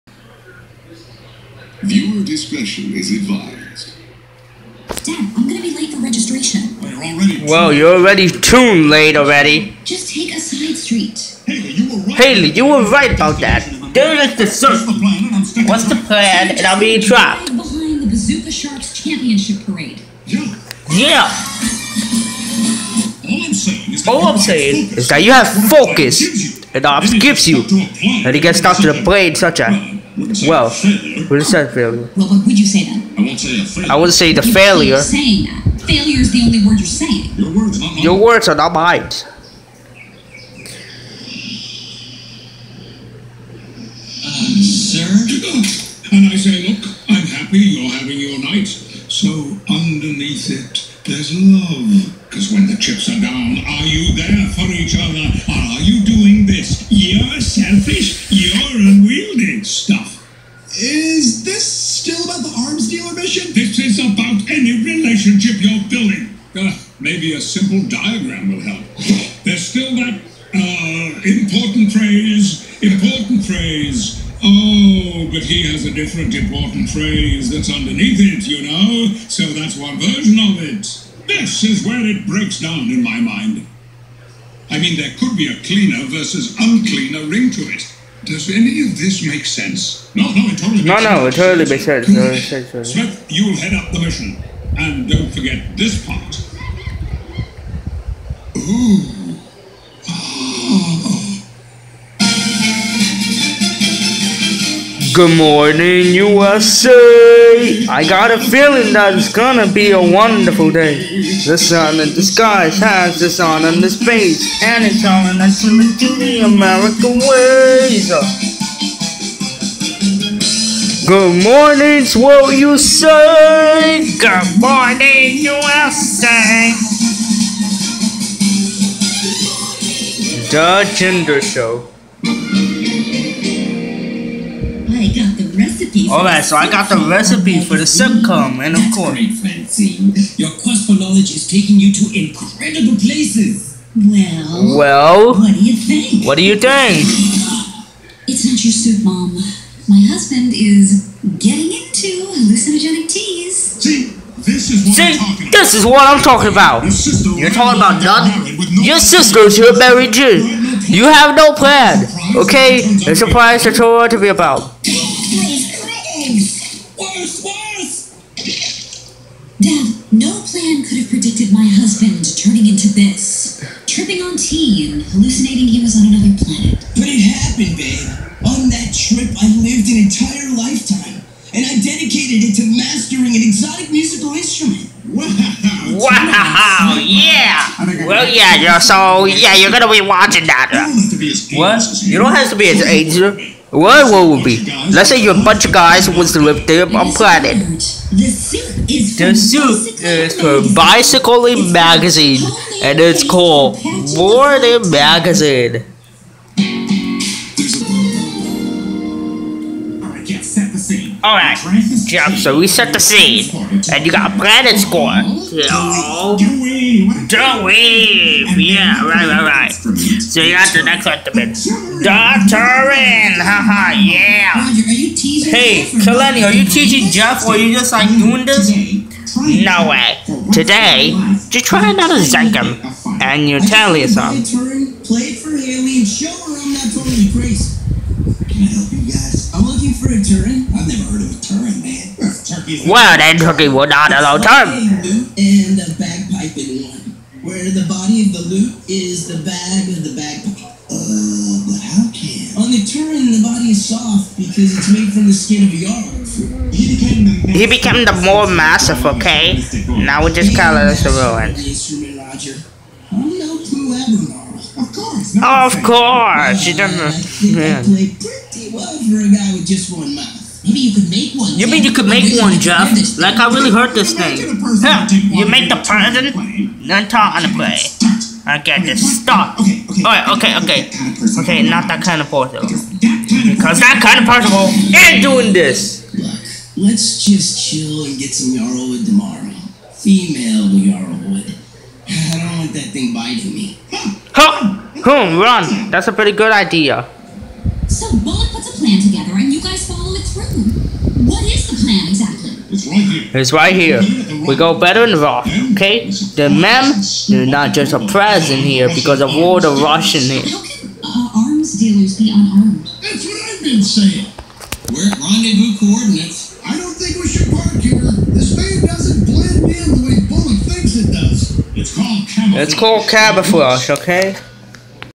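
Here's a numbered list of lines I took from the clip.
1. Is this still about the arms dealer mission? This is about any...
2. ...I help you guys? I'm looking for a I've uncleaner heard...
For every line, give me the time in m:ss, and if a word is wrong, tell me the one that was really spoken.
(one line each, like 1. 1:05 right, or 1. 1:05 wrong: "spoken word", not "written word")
1. 1:00 right
2. 3:58 wrong: "never", not "uncleaner".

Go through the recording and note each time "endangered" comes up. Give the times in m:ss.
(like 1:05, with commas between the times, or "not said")
not said.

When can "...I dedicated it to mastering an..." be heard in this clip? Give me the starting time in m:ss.
3:01.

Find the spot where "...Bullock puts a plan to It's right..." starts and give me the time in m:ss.
4:58.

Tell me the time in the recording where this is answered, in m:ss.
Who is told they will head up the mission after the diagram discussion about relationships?
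1:32.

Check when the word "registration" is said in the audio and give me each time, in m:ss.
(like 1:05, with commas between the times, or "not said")
0:06.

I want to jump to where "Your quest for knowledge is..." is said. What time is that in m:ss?
2:20.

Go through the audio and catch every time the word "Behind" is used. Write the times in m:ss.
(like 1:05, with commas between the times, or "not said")
0:17.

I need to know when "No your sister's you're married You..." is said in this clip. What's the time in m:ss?
2:38.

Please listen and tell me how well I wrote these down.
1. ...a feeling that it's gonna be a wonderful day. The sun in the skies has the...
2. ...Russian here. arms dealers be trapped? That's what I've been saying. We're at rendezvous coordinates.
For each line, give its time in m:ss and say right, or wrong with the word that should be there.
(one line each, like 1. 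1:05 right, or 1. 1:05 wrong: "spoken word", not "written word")
1. 1:48 right
2. 5:09 wrong: "unarmed", not "trapped".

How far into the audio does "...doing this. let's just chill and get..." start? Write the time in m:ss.
4:45.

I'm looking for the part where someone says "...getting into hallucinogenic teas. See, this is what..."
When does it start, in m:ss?
2:31.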